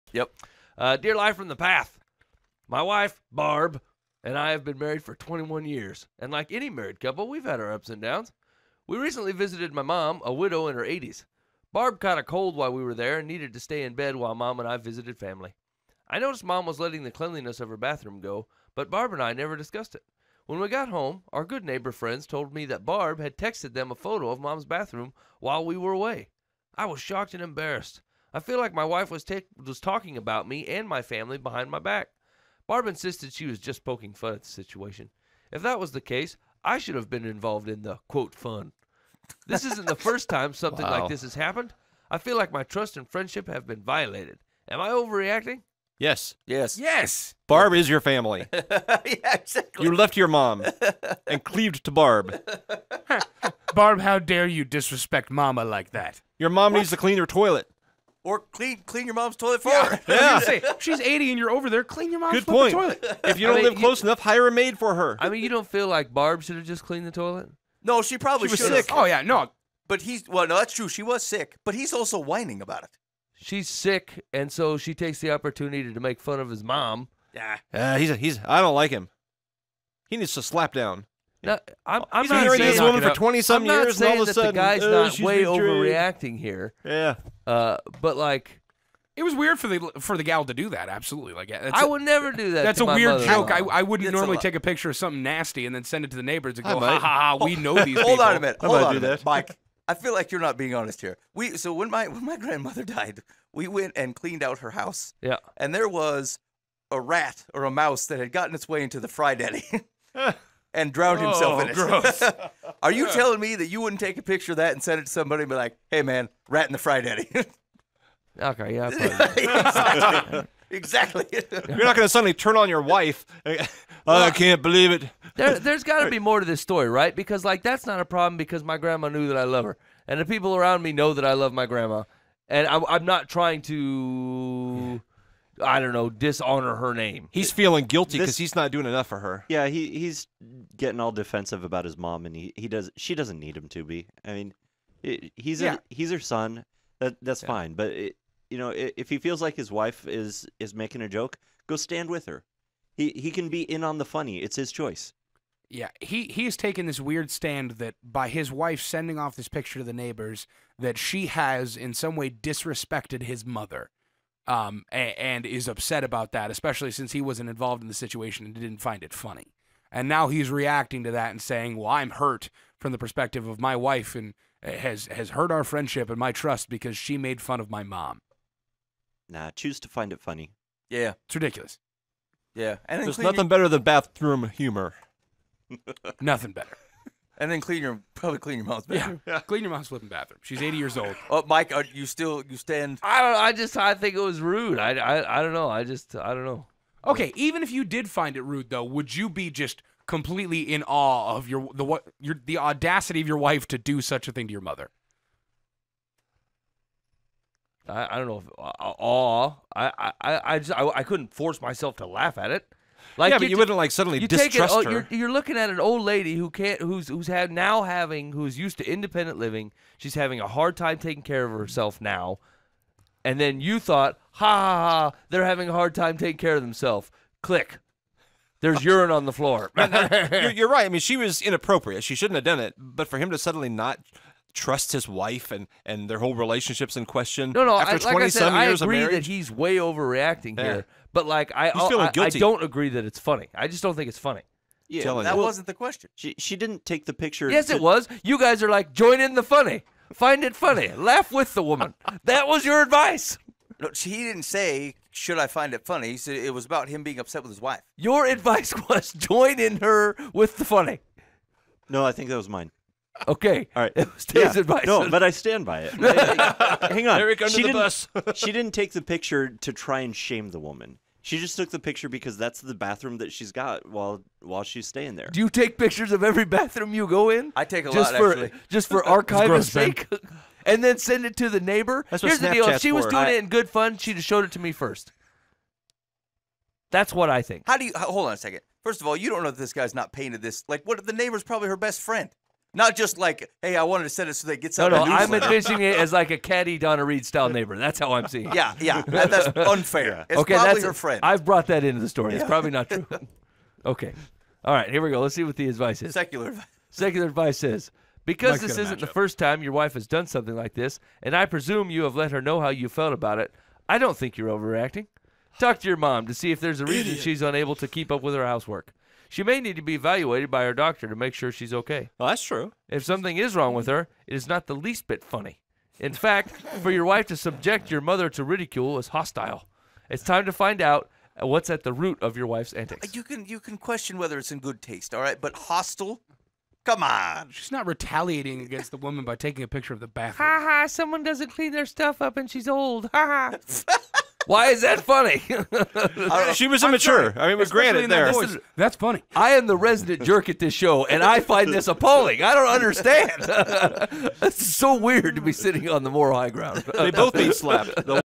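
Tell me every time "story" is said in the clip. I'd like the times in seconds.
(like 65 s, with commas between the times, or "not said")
126 s, 302 s.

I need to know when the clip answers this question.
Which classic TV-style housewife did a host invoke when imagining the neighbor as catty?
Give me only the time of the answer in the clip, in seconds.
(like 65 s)
296 s.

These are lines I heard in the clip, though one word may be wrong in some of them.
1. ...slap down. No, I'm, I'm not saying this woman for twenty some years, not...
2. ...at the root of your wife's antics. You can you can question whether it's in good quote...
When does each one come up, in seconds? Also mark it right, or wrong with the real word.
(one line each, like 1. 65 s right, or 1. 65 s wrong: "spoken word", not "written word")
1. 80 s right
2. 331 s wrong: "taste", not "quote".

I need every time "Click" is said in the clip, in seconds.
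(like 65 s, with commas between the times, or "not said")
227 s.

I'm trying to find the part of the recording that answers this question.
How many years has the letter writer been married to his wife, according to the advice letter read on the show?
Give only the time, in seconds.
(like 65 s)
5 s.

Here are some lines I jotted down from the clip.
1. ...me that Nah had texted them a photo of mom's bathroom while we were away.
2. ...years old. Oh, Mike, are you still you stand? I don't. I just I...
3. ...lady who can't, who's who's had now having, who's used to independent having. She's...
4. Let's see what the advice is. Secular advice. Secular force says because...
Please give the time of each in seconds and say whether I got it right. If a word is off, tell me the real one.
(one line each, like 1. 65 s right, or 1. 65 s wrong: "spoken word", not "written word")
1. 22 s wrong: "Barb", not "Nah"
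2. 190 s right
3. 216 s wrong: "living", not "having"
4. 305 s wrong: "advice", not "force".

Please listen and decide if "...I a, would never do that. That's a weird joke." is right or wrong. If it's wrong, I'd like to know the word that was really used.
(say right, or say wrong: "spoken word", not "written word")
right.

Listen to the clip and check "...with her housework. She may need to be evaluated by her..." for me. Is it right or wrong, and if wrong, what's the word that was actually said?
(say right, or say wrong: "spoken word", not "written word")
right.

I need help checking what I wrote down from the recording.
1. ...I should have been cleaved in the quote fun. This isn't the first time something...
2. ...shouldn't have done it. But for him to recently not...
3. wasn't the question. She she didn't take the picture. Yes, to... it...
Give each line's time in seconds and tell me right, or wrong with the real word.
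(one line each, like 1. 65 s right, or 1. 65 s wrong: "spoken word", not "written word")
1. 36 s wrong: "involved", not "cleaved"
2. 232 s wrong: "suddenly", not "recently"
3. 245 s right.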